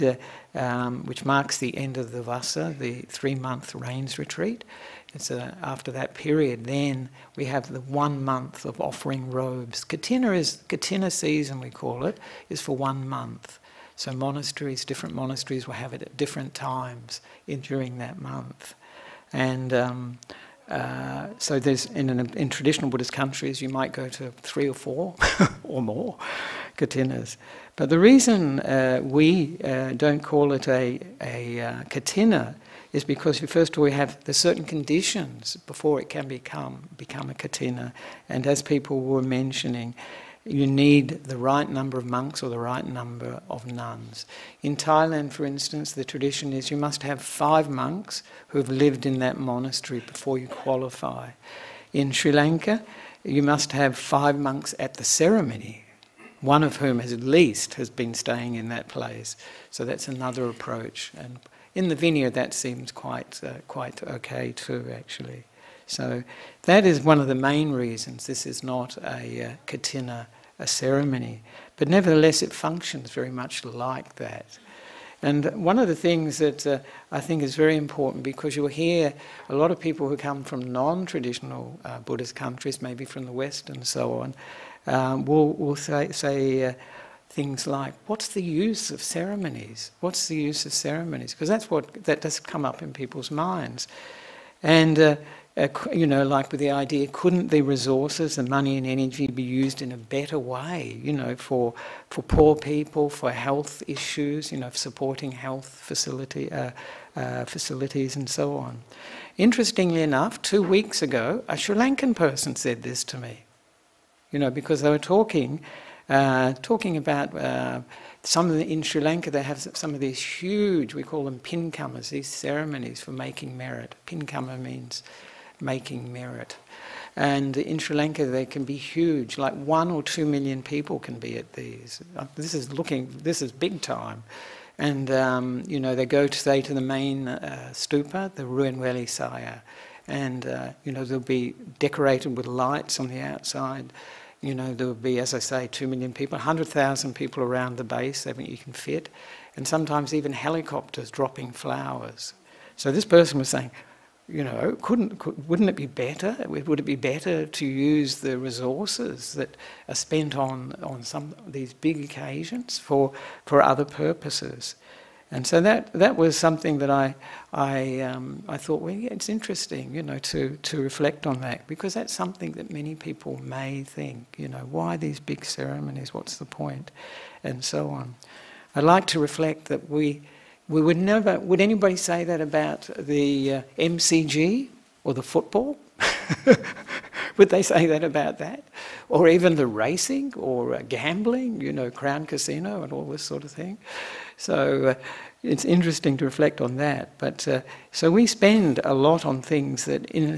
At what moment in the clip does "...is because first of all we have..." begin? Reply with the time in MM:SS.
00:32.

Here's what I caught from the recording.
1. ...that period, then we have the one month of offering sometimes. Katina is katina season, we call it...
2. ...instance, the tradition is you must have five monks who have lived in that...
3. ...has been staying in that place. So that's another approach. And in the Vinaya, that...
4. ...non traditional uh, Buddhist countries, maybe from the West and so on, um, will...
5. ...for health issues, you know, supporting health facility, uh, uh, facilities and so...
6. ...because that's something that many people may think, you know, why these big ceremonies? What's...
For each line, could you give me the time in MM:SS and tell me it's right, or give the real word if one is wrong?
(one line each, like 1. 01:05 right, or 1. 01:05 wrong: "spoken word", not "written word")
1. 00:05 wrong: "robes", not "sometimes"
2. 00:45 right
3. 00:57 right
4. 01:20 right
5. 01:43 right
6. 02:51 right.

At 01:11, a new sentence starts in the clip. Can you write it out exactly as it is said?
But nevertheless, it functions very much like that.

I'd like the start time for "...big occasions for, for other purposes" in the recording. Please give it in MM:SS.
02:41.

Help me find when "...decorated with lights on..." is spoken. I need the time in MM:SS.
02:21.